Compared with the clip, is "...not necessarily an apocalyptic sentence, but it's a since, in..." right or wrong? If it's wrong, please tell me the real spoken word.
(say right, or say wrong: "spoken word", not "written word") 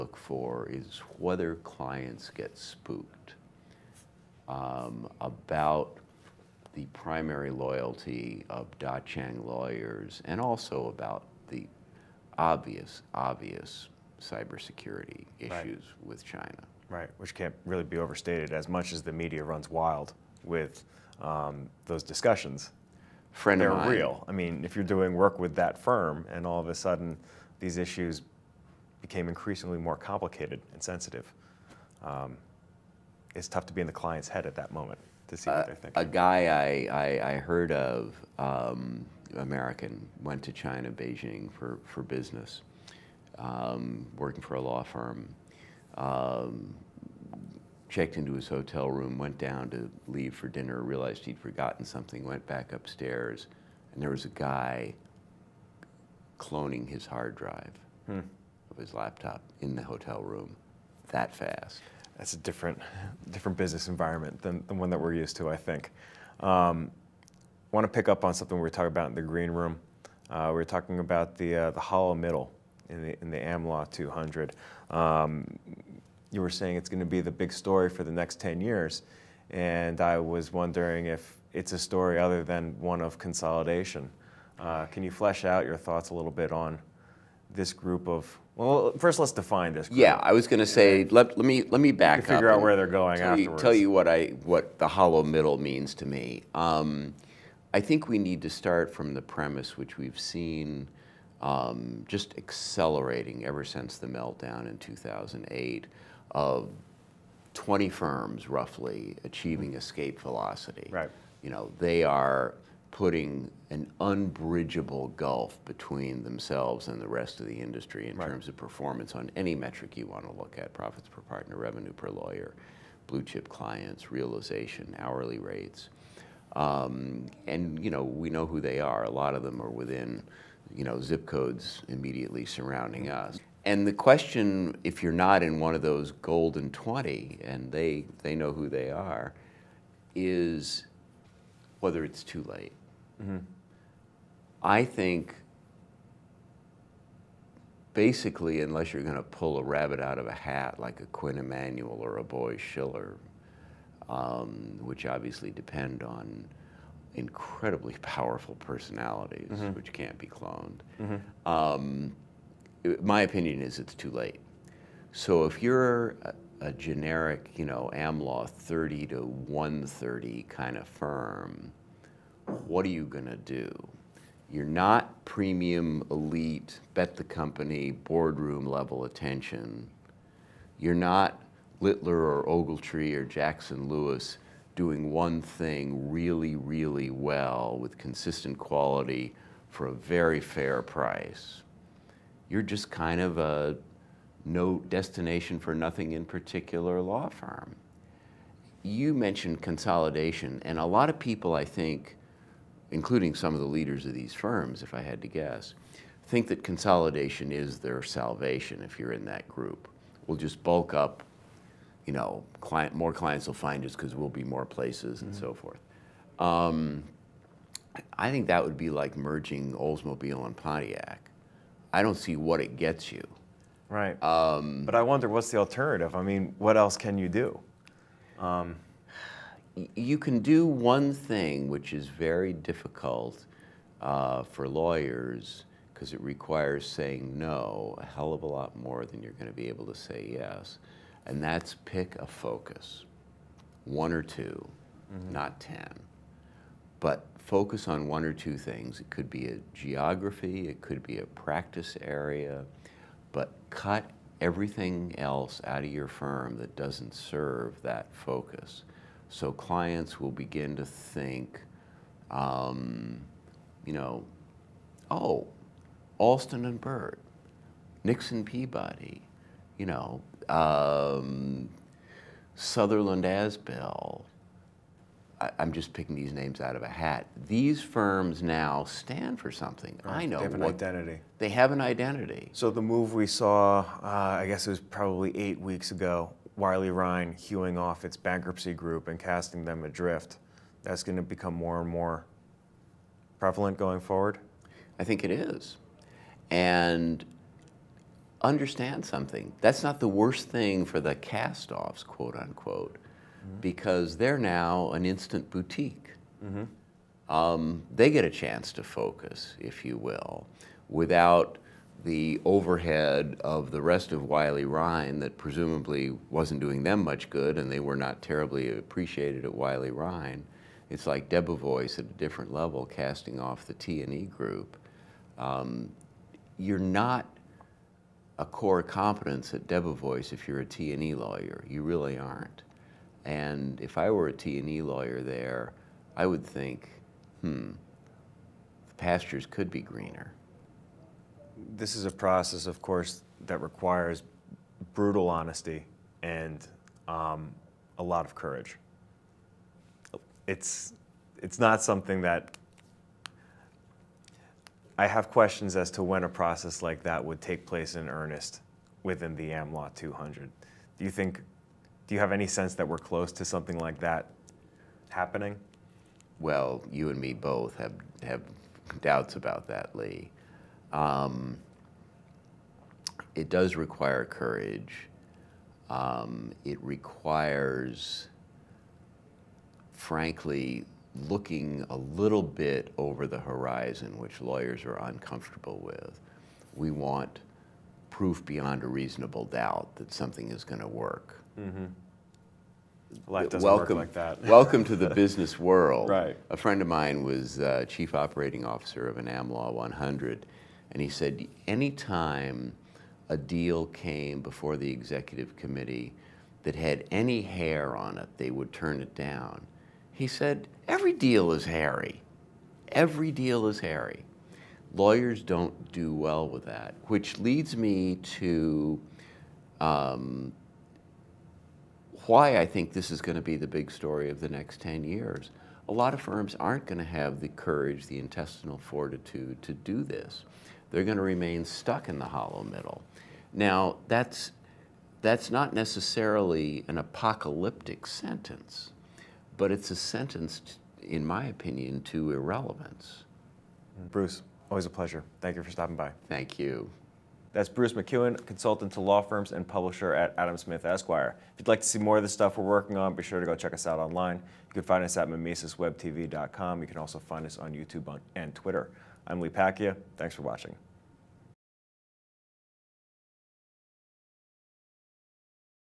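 wrong: "sentence", not "since".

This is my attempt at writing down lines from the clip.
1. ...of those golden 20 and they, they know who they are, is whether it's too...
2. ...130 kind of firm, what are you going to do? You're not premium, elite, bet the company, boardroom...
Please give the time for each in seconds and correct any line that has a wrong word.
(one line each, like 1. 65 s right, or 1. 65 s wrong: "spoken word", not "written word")
1. 135 s right
2. 169 s right.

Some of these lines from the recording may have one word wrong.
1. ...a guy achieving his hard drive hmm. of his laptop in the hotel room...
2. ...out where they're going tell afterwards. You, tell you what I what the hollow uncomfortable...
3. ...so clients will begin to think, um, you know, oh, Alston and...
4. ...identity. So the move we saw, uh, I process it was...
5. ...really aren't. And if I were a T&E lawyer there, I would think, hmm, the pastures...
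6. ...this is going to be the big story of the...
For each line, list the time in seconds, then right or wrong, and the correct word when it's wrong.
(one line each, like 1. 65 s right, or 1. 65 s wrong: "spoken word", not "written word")
1. 54 s wrong: "cloning", not "achieving"
2. 92 s wrong: "middle", not "uncomfortable"
3. 259 s right
4. 281 s wrong: "guess", not "process"
5. 331 s right
6. 422 s right.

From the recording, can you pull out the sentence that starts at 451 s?
If you'd like to see more of the stuff we're working on, be sure to go check us out online.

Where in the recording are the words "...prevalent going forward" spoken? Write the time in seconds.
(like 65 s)
293 s.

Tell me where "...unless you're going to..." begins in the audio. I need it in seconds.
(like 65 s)
148 s.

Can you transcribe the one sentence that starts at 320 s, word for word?
It's like Debevoise at a different level casting off the T&E group.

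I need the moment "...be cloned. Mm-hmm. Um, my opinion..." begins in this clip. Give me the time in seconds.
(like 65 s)
160 s.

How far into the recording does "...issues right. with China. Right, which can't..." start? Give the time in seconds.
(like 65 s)
15 s.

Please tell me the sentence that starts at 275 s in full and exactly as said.
I, am just picking these names out of a hat.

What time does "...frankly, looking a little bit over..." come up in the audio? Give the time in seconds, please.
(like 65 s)
379 s.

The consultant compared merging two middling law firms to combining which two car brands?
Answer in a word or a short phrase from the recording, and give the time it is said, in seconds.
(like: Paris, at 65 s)
Oldsmobile and Pontiac, at 219 s.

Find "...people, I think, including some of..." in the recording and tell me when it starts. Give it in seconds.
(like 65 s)
201 s.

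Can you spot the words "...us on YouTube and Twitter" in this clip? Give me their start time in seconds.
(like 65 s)
457 s.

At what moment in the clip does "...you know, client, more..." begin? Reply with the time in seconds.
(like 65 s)
212 s.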